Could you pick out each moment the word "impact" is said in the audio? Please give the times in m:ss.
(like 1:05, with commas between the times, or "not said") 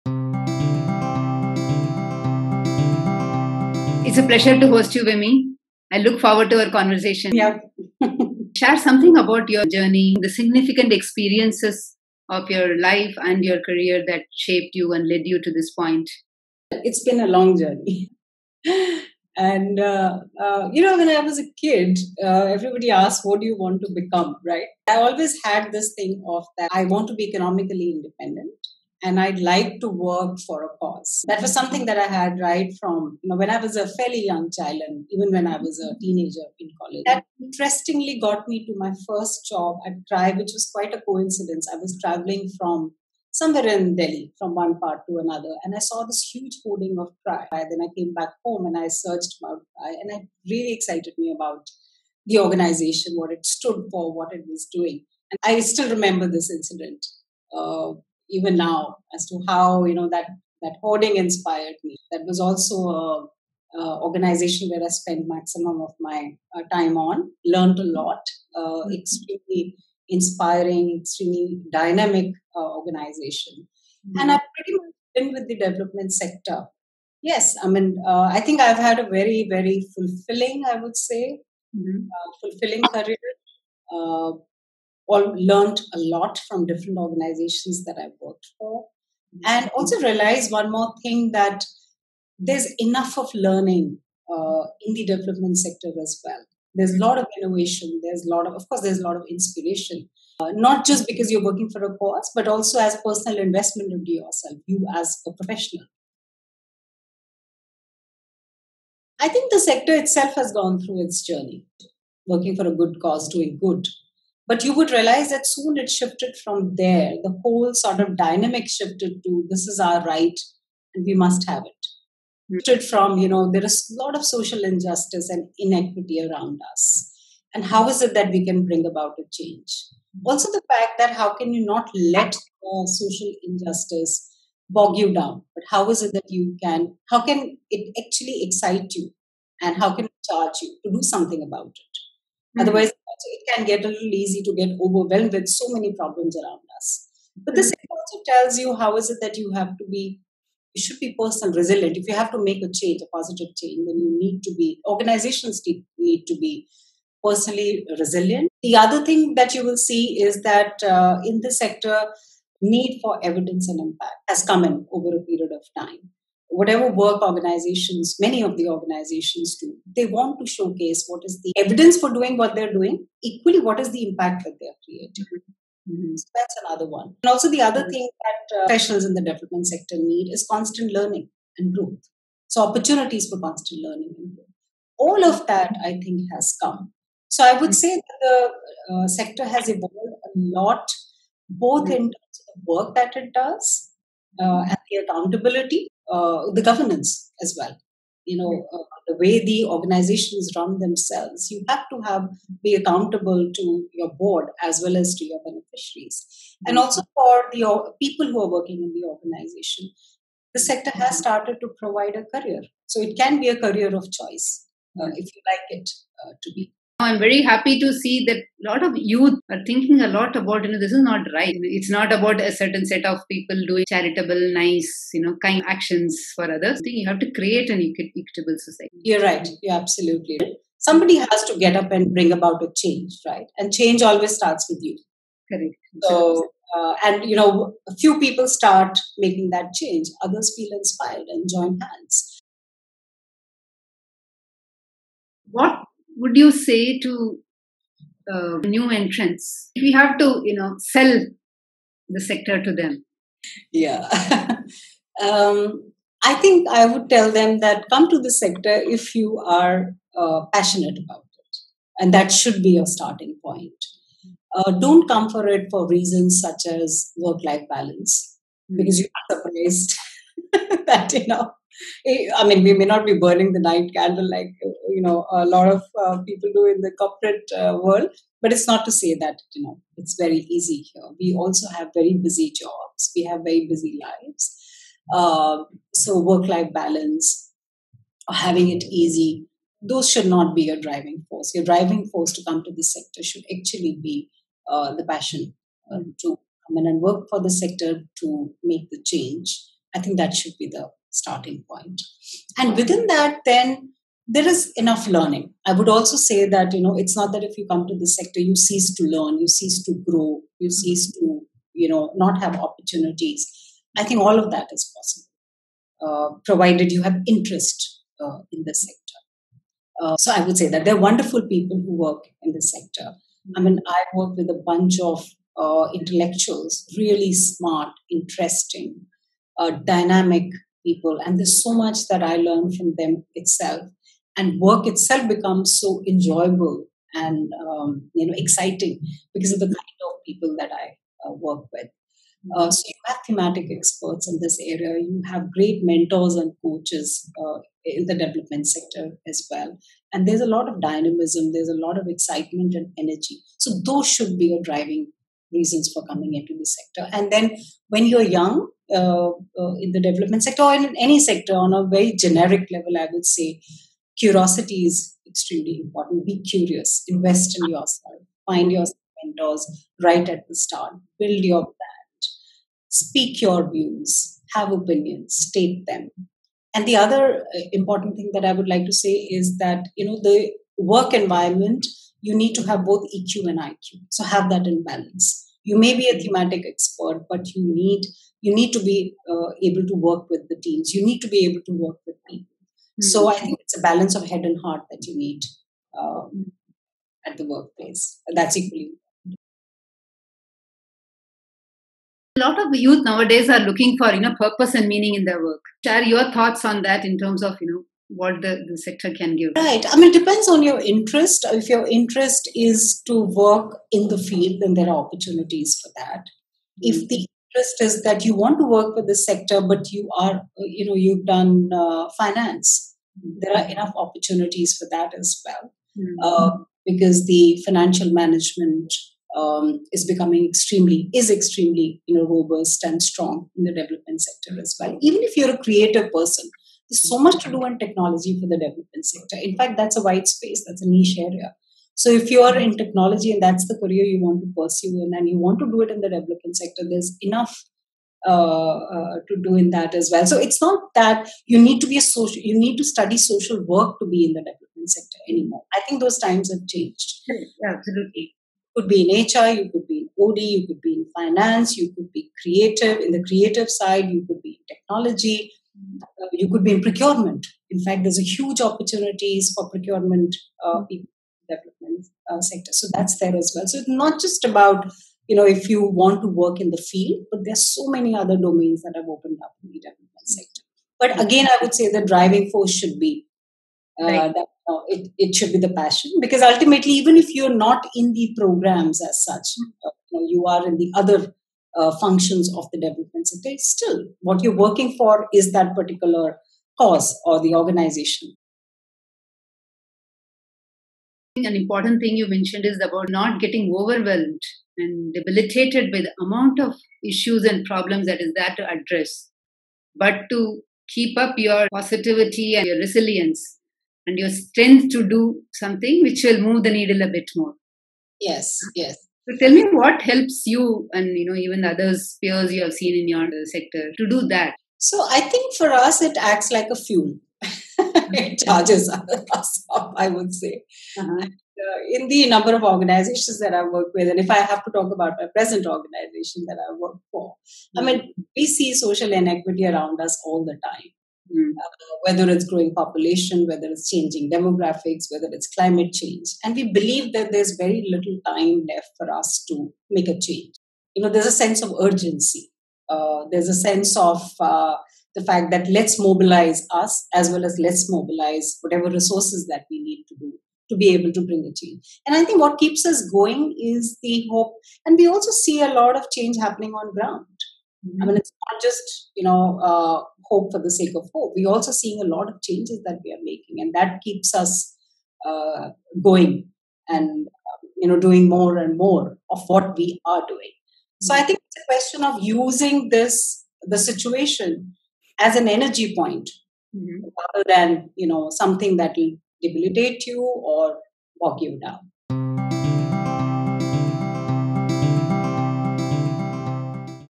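2:43, 2:54.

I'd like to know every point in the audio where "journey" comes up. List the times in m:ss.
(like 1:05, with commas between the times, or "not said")
0:09, 0:17, 1:51.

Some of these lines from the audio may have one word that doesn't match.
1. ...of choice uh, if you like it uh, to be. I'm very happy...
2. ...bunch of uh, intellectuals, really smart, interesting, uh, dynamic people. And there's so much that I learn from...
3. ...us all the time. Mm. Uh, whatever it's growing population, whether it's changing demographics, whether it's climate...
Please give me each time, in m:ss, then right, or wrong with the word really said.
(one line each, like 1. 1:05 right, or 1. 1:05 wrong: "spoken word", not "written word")
1. 3:33 right
2. 5:24 right
3. 9:00 wrong: "whether", not "whatever".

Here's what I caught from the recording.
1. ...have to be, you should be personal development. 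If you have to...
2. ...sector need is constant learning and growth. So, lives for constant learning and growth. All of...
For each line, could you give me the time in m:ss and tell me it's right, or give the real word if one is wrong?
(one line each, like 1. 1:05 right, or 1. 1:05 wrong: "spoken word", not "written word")
1. 2:29 wrong: "resilient", not "development"
2. 2:59 wrong: "opportunities", not "lives".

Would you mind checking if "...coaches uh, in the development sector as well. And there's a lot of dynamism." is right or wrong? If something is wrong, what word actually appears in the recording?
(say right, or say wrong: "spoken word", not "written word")
right.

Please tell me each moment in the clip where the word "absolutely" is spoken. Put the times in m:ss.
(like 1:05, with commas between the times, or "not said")
3:49, 7:37.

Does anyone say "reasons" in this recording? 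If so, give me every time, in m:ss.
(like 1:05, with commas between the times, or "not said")
4:25, 5:55.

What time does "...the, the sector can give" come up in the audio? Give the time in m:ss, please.
6:48.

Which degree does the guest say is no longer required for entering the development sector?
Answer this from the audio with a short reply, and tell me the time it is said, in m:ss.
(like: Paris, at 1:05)
Social work, at 7:33.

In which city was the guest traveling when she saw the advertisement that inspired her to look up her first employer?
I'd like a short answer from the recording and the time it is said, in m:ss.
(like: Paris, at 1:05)
Delhi, at 0:43.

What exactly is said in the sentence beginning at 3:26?
also for the people who are working in the organization.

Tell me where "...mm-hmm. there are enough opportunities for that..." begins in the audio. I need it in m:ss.
7:03.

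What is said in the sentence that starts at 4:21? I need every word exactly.
And that should be your starting point.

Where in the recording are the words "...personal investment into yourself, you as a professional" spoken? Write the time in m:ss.
1:43.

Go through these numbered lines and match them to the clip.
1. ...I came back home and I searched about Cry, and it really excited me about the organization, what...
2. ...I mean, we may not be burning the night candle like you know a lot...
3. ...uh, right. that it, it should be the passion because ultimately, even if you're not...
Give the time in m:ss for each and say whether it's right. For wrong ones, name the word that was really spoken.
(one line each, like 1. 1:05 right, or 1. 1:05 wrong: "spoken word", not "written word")
1. 0:47 right
2. 4:32 right
3. 8:04 right.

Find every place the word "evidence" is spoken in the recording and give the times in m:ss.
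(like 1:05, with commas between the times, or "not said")
2:43, 2:51.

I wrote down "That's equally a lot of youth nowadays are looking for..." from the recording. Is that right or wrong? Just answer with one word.
right.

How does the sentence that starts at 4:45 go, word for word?
Uh, so work-life balance, having it easy, those should not be your driving force.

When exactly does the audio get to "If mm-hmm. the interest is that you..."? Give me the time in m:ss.
6:56.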